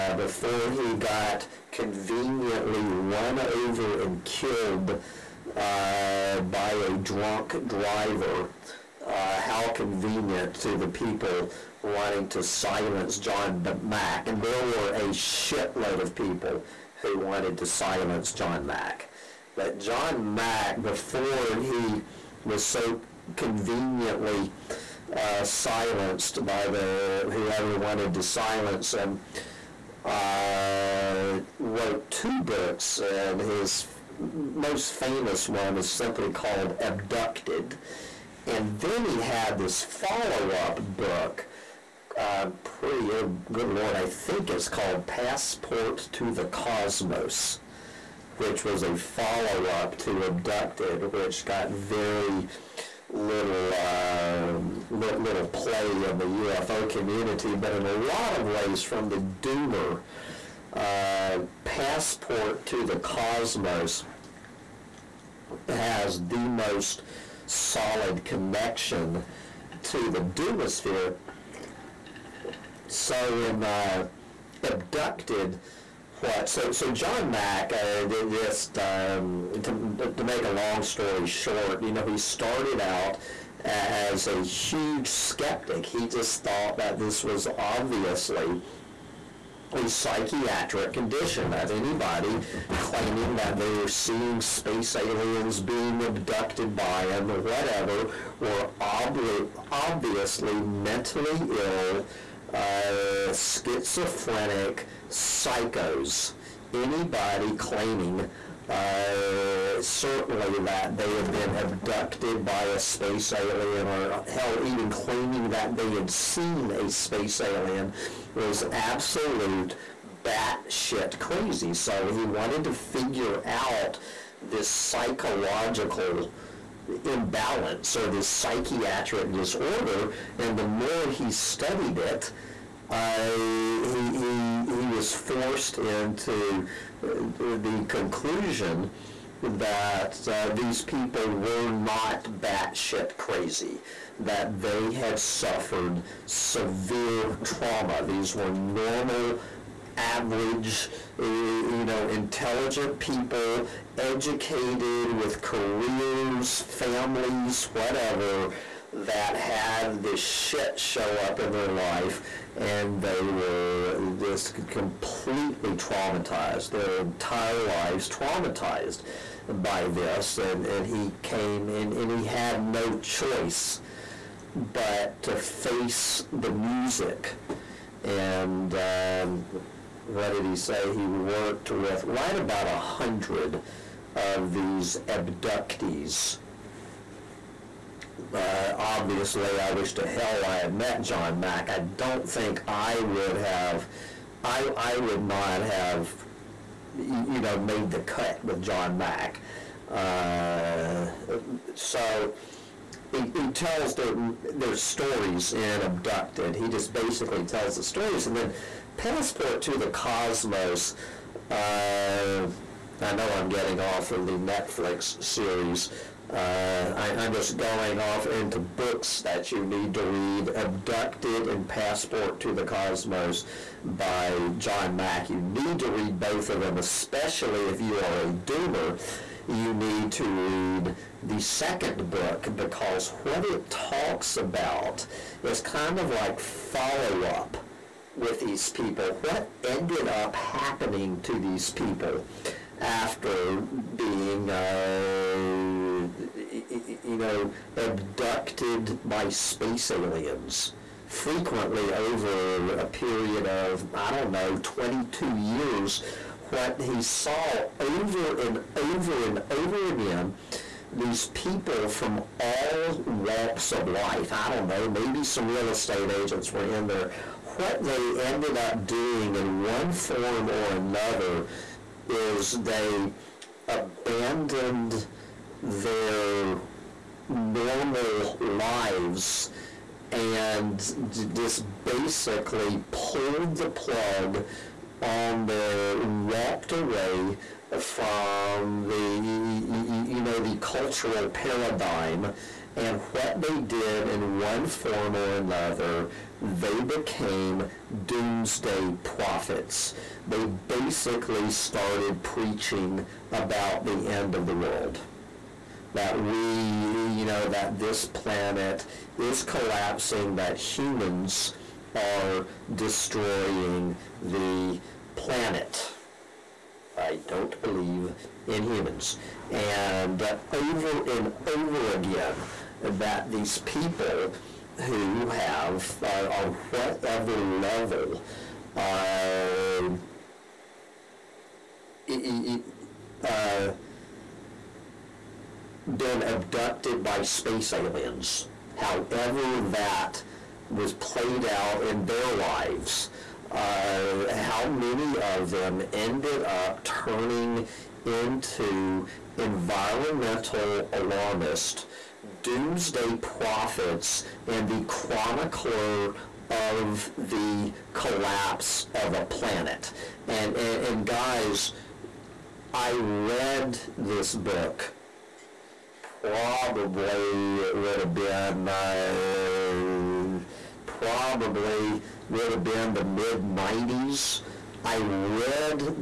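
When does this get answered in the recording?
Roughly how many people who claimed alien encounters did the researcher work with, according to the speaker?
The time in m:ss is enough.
3:02.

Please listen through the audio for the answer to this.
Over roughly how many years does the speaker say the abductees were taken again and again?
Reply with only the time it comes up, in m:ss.
4:14.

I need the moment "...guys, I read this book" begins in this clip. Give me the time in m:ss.
6:01.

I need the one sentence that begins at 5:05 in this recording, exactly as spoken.
That we, you know, that this planet is collapsing, that humans are destroying the planet.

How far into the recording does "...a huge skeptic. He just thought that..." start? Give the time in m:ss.
1:24.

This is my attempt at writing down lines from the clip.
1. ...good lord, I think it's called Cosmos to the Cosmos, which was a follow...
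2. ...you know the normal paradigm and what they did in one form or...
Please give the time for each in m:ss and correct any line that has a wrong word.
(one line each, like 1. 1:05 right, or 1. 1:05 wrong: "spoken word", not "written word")
1. 0:43 wrong: "Passport", not "Cosmos"
2. 4:48 wrong: "cultural", not "normal".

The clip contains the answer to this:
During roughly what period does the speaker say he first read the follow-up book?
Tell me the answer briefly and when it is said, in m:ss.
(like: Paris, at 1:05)
mid 90s, at 6:13.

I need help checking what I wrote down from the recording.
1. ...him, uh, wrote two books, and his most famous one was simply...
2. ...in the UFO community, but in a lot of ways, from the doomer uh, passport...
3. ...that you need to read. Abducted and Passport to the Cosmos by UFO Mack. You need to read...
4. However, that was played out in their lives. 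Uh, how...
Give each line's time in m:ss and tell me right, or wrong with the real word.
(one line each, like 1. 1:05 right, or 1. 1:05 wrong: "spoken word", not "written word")
1. 0:28 right
2. 0:56 right
3. 3:39 wrong: "John", not "UFO"
4. 5:38 right.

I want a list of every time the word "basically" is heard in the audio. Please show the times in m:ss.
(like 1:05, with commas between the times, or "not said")
3:26, 4:41, 5:00.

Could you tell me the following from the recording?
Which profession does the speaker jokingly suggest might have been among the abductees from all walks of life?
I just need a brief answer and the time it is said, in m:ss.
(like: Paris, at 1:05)
real estate agents, at 4:25.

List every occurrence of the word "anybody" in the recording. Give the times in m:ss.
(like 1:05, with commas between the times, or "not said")
1:31, 1:46.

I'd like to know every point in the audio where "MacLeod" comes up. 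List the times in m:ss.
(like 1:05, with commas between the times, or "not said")
not said.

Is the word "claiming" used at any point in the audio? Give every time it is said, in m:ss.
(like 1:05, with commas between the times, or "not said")
1:32, 1:47, 1:54.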